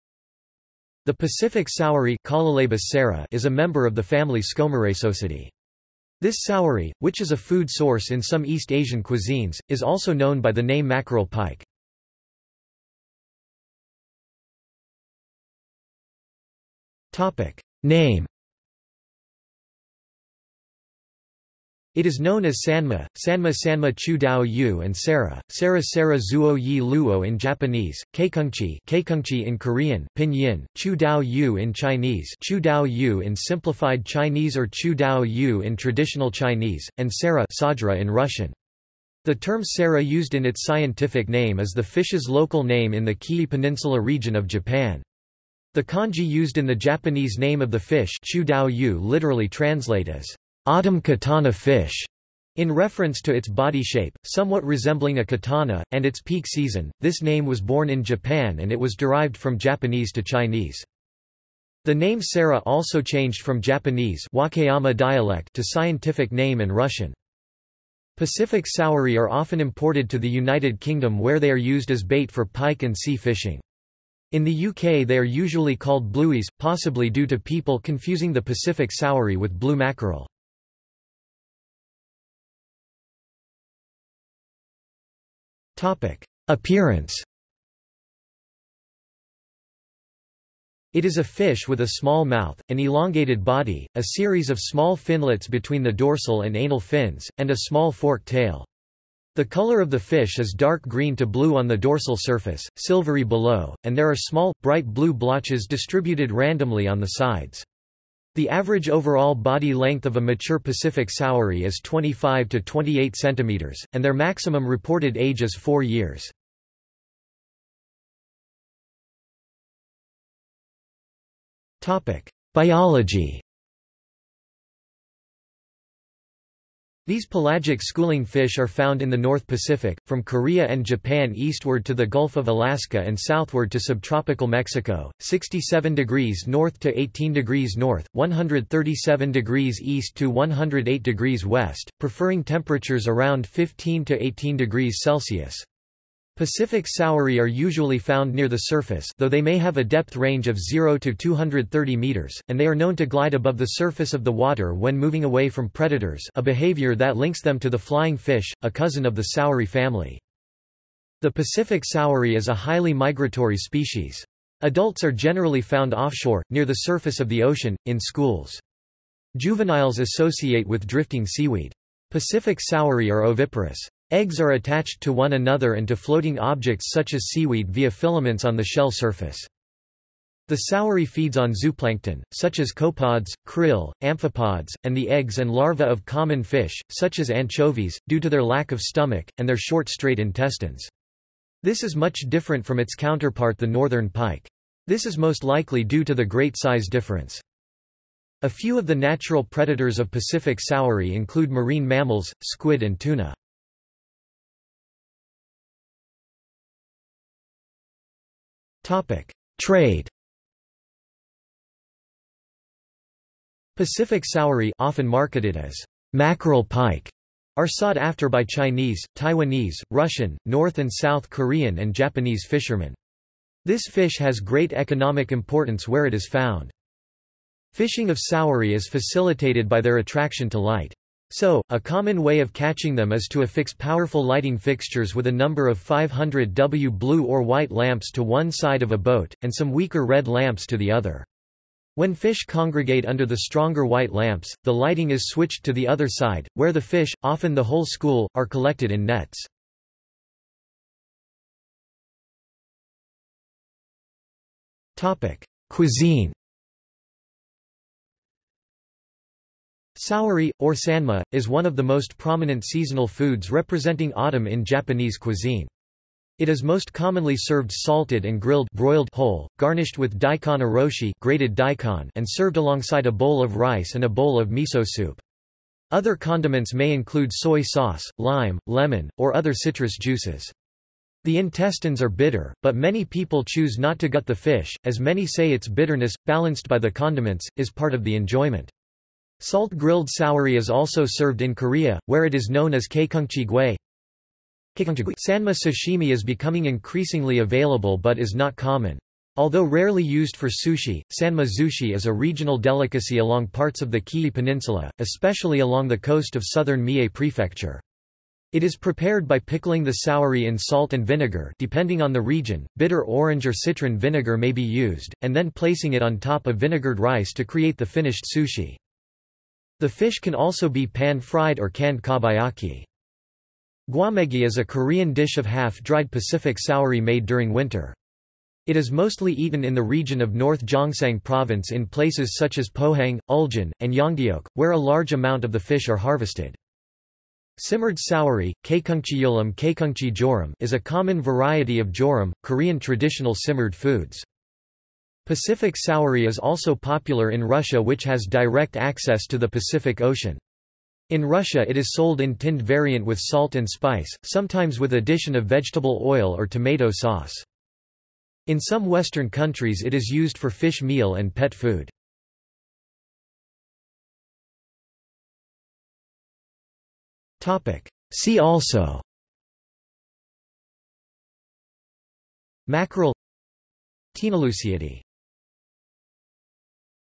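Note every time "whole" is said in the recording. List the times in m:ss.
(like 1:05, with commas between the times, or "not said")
4:07, 4:29.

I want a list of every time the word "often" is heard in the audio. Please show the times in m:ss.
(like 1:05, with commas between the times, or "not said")
1:09, 3:34, 4:07.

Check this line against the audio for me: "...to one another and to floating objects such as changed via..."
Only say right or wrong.
wrong.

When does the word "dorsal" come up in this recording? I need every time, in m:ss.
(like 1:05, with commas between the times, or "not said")
1:35, 1:41.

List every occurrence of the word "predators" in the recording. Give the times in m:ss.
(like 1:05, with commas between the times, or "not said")
2:35, 3:19.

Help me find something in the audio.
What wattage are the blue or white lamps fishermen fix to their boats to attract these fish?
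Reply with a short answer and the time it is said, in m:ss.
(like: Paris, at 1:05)
500 W, at 3:55.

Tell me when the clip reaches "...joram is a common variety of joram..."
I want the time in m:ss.
5:40.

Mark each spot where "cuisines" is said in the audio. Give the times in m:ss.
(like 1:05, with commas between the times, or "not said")
0:09, 4:15, 4:25.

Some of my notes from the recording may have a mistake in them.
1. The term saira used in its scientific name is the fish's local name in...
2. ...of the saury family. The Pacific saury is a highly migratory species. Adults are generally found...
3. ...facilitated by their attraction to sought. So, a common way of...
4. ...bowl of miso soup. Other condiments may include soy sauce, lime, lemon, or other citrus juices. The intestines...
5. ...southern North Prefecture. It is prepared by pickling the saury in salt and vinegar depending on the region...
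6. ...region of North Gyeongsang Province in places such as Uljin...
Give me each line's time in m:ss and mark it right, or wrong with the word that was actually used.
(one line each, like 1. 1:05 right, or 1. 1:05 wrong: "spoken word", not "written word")
1. 0:39 right
2. 2:39 right
3. 3:48 wrong: "light", not "sought"
4. 4:34 right
5. 5:06 wrong: "Mie", not "North"
6. 5:29 wrong: "Pohang", not "Uljin".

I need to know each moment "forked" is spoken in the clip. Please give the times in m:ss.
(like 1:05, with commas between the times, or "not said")
1:37.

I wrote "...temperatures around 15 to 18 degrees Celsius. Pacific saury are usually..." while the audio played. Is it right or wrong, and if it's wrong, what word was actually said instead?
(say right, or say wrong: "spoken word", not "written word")
right.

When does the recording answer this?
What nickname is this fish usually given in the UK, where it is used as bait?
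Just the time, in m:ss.
1:16.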